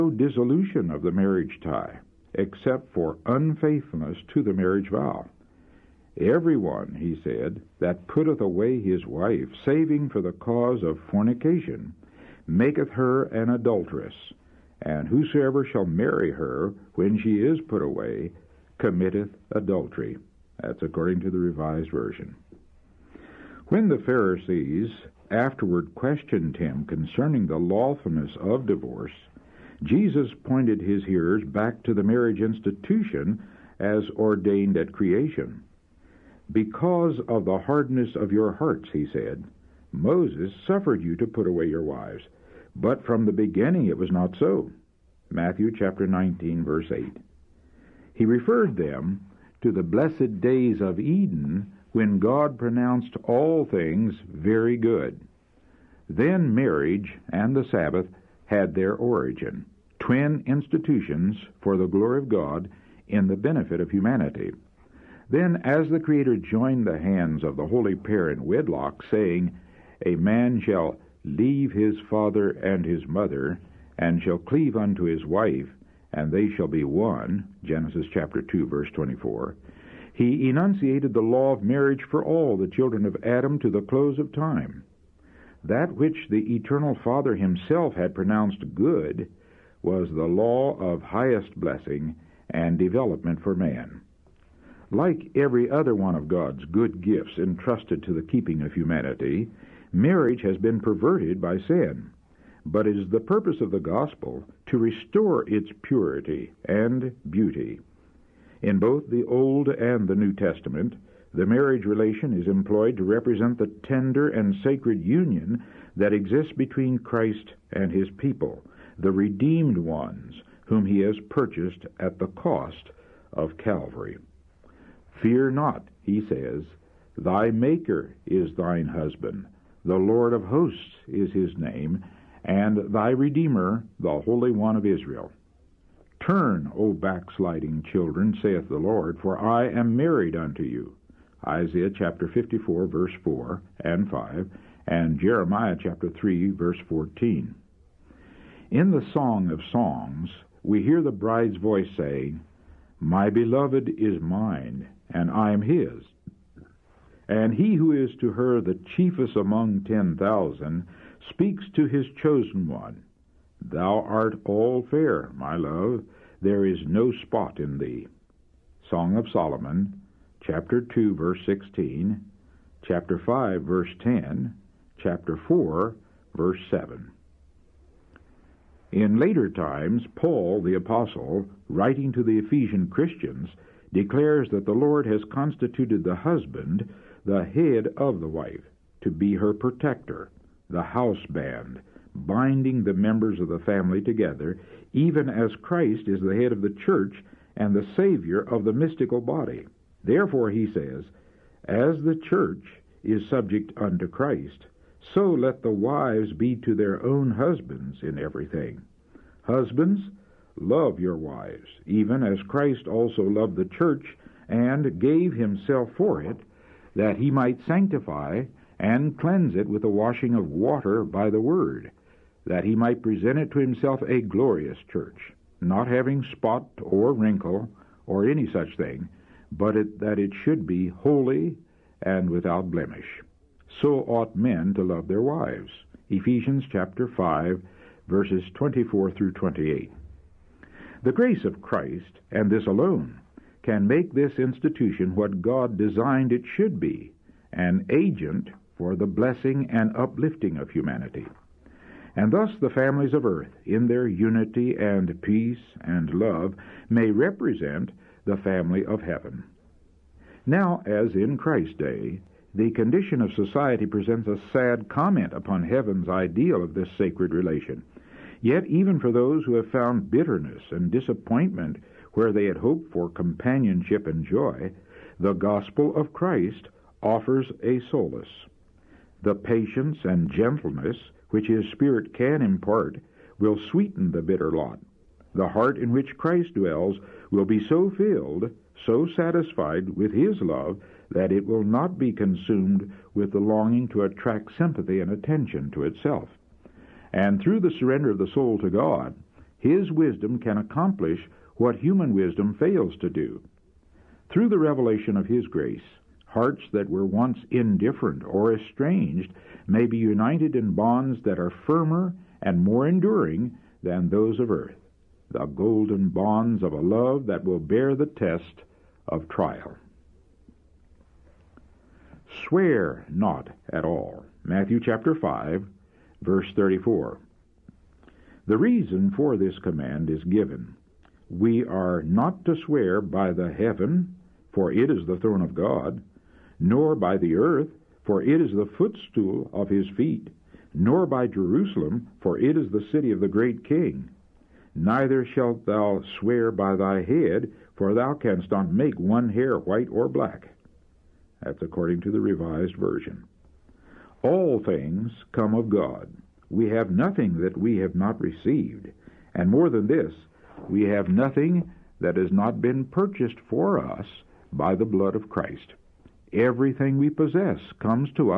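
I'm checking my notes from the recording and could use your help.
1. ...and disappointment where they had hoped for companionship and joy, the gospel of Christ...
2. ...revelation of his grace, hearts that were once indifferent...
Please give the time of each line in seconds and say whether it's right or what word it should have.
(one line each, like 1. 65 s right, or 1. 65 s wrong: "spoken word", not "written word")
1. 270 s right
2. 304 s right.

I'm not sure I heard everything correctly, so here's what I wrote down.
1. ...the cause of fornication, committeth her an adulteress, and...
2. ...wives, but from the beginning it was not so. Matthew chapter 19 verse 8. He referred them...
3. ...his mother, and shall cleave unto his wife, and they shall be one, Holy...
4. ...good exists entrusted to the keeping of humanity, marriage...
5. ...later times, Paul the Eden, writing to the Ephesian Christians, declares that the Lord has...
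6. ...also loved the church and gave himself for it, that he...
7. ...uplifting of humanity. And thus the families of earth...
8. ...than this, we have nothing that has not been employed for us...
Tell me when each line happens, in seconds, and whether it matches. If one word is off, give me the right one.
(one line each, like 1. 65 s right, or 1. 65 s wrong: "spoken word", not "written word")
1. 10 s wrong: "maketh", not "committeth"
2. 41 s right
3. 72 s wrong: "Genesis", not "Holy"
4. 96 s wrong: "gifts", not "exists"
5. 179 s wrong: "Apostle", not "Eden"
6. 212 s right
7. 249 s right
8. 359 s wrong: "purchased", not "employed".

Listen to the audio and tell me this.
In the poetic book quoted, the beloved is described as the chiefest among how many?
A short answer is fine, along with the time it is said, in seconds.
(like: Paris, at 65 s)
10,000, at 159 s.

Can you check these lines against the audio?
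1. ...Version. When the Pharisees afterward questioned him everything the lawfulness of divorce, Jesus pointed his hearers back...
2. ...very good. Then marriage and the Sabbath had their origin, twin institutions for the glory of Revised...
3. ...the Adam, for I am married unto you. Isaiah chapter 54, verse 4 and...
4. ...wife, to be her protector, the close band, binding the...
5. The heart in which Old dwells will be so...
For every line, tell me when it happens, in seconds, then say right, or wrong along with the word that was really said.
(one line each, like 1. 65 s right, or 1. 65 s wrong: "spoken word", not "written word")
1. 21 s wrong: "concerning", not "everything"
2. 54 s wrong: "God", not "Revised"
3. 138 s wrong: "Lord", not "Adam"
4. 188 s wrong: "house", not "close"
5. 285 s wrong: "Christ", not "Old".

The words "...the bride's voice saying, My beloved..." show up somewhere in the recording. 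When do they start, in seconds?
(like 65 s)
151 s.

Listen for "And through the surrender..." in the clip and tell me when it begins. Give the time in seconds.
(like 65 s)
297 s.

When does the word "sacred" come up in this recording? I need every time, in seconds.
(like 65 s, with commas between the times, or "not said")
114 s, 266 s.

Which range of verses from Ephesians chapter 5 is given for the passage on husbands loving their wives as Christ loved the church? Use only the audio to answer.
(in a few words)
Verses 24–28.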